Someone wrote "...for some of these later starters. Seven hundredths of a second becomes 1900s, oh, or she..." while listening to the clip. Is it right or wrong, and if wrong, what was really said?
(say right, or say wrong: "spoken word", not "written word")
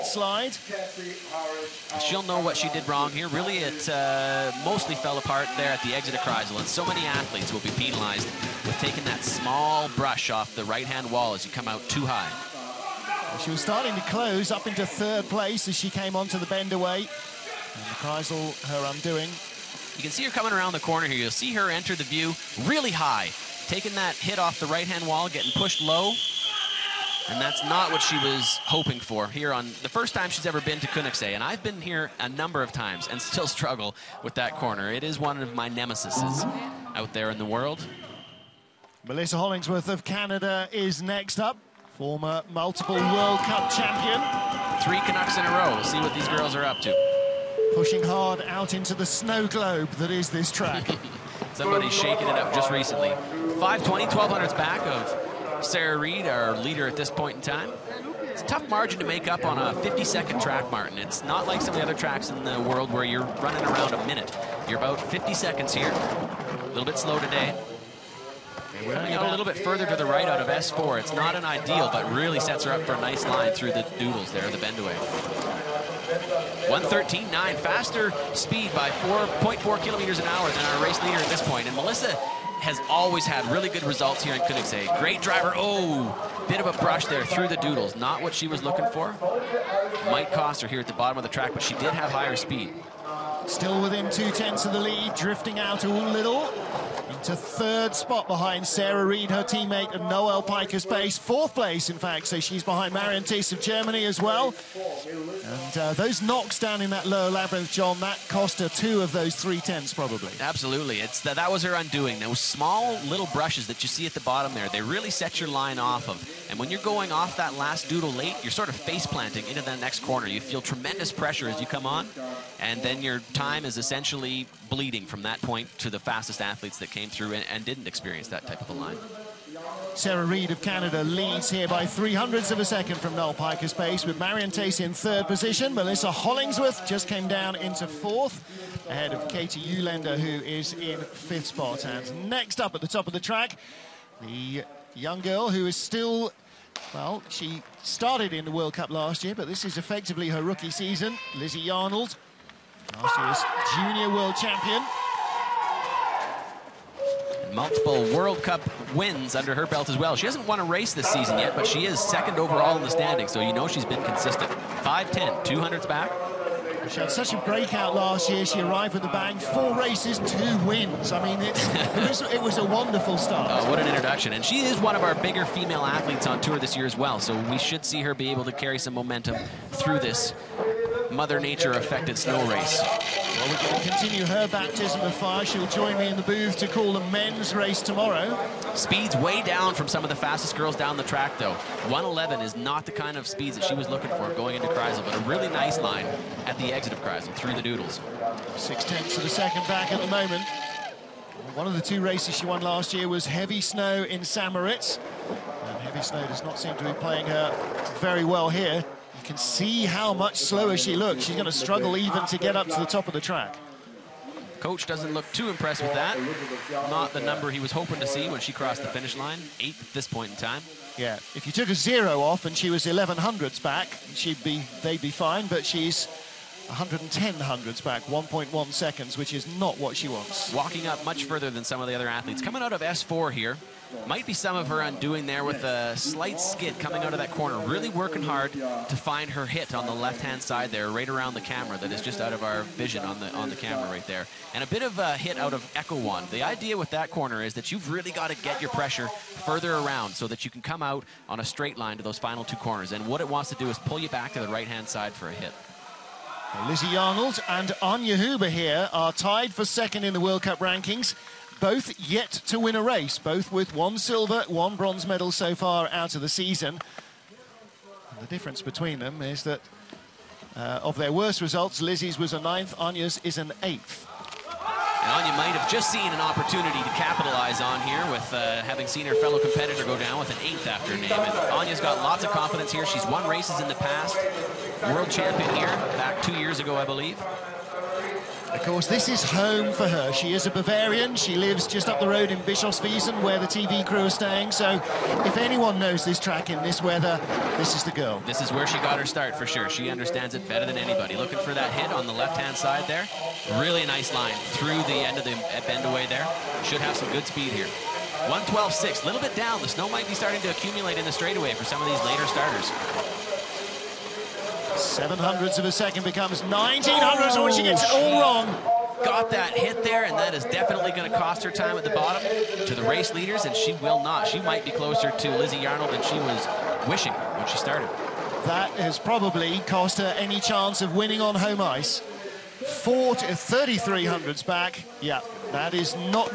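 right.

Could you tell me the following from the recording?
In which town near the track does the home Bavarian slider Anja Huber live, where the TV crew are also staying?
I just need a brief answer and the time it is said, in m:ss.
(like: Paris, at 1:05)
Bischofswiesen, at 4:52.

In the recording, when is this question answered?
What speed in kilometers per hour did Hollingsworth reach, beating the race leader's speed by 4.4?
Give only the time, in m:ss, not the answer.
1:16.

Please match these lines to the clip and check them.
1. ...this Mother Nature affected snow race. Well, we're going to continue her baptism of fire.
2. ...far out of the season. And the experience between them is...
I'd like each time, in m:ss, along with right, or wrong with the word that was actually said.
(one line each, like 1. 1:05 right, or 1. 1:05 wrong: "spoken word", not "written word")
1. 2:59 right
2. 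4:25 wrong: "difference", not "experience".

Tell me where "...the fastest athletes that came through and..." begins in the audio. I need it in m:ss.
2:05.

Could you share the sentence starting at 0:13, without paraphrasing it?
She was starting to close up into third place as she came onto the bend away.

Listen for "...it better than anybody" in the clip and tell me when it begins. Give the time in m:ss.
5:00.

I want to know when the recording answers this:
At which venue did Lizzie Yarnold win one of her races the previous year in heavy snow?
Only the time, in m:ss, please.
3:24.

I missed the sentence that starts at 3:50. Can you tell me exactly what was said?
Walking up much further than some of the other athletes.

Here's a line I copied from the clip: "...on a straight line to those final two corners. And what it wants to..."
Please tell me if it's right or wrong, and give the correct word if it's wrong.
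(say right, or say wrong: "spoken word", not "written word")
right.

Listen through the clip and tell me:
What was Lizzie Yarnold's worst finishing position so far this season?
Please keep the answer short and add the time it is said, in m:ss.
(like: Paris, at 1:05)
ninth, at 4:32.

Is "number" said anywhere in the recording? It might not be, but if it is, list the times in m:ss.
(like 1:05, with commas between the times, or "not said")
0:32, 3:37.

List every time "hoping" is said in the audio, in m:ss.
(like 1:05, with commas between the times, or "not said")
0:28, 3:37.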